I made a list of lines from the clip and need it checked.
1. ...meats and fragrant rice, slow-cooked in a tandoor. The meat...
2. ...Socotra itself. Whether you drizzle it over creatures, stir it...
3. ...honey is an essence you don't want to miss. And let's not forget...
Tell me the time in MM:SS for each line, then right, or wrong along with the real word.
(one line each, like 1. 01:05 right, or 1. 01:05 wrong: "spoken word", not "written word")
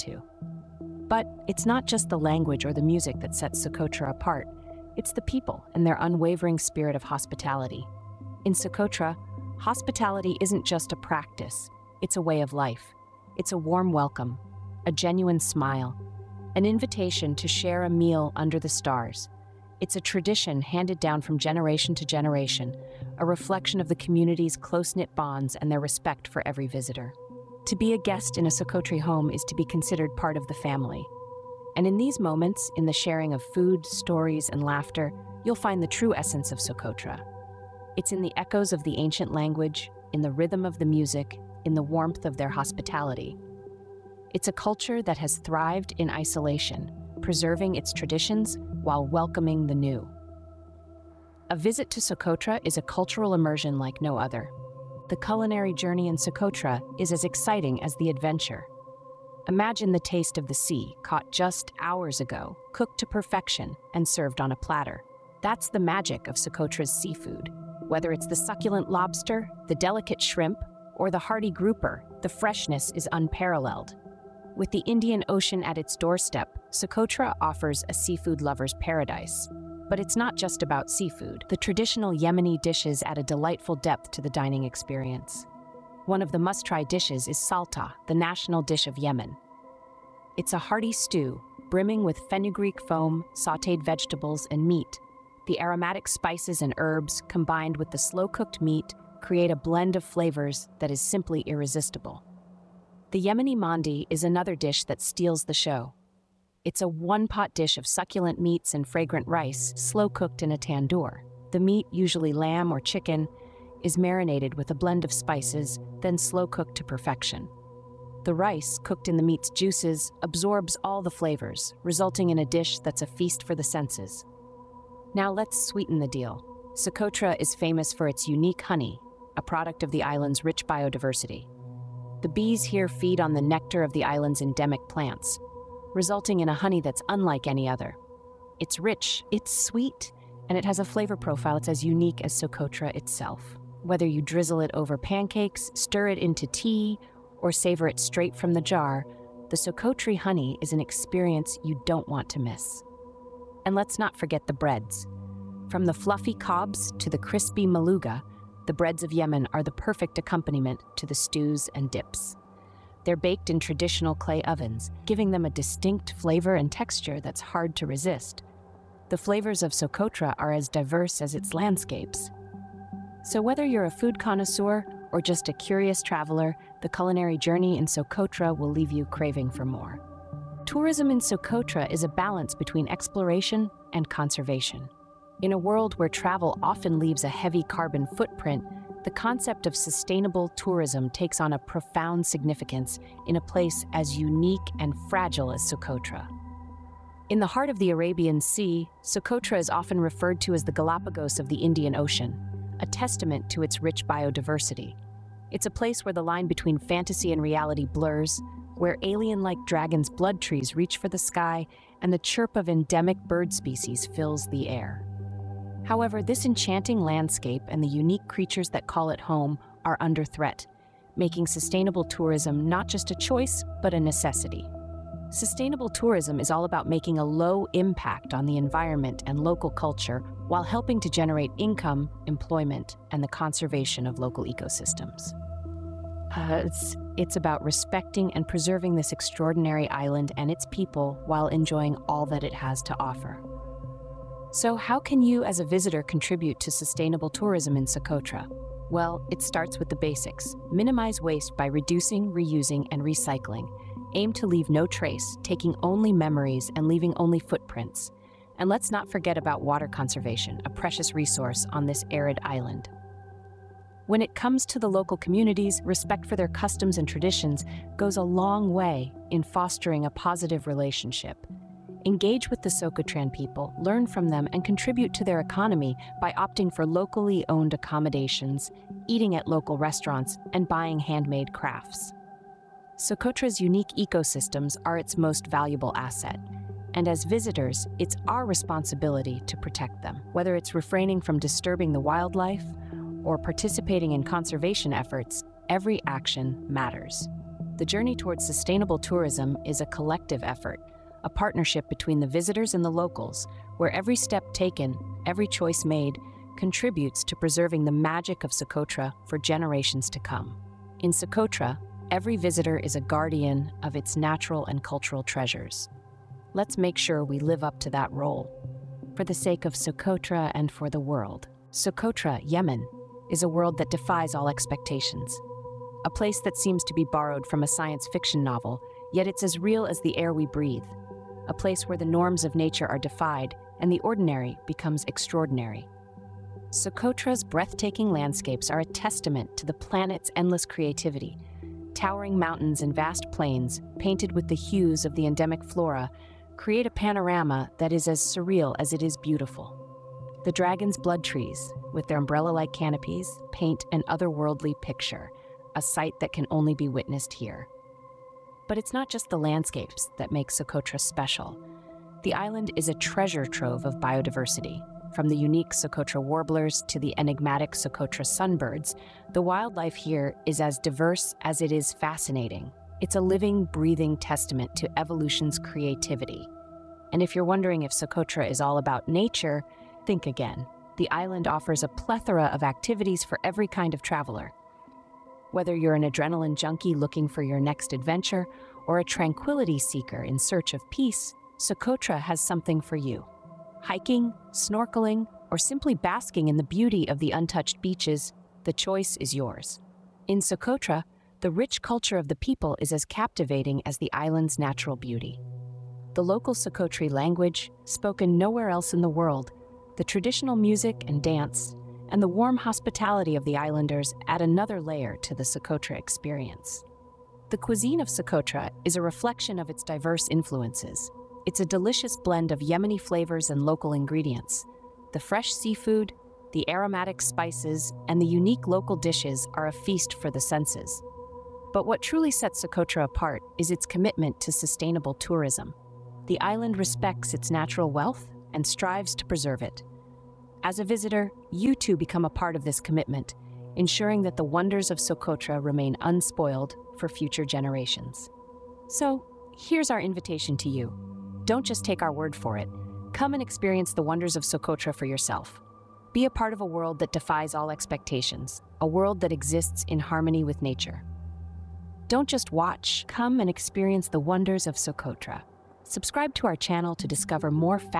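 1. 01:48 right
2. 02:22 wrong: "pancakes", not "creatures"
3. 02:30 wrong: "experience", not "essence".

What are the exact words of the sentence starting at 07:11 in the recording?
But what truly sets Socotra apart is its commitment to sustainable tourism.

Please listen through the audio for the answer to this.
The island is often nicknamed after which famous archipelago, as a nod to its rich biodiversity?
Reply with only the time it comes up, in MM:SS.
03:20.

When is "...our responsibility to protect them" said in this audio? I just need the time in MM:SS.
04:48.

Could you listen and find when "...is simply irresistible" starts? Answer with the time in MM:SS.
01:40.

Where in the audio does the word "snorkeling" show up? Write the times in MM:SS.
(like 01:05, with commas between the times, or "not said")
06:34.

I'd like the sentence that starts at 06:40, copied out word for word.
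In Socotra, the rich culture of the people is as captivating as the island's natural beauty.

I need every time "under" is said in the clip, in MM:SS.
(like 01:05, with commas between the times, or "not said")
00:18, 03:40.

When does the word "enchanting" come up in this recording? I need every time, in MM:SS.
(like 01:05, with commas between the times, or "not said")
03:36.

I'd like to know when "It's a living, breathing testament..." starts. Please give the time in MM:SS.
06:13.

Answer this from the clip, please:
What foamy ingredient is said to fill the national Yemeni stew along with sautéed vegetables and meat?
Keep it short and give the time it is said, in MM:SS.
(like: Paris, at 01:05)
Fenugreek foam, at 01:32.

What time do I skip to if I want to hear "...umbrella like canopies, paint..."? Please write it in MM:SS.
05:52.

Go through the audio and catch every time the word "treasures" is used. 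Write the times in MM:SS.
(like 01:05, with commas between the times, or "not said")
05:15, 06:02.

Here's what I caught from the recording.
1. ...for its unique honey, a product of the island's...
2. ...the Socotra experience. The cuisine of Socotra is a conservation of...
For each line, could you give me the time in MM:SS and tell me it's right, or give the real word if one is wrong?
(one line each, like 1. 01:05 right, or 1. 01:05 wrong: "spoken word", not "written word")
1. 02:07 right
2. 06:55 wrong: "reflection", not "conservation".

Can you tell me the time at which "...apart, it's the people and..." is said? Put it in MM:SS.
00:04.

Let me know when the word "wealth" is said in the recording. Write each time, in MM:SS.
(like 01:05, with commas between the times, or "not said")
07:17.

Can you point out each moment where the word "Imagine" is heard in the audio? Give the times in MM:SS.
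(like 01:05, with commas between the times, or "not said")
00:59.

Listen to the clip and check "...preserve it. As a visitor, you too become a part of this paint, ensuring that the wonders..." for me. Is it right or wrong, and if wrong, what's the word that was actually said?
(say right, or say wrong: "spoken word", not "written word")
wrong: "commitment", not "paint".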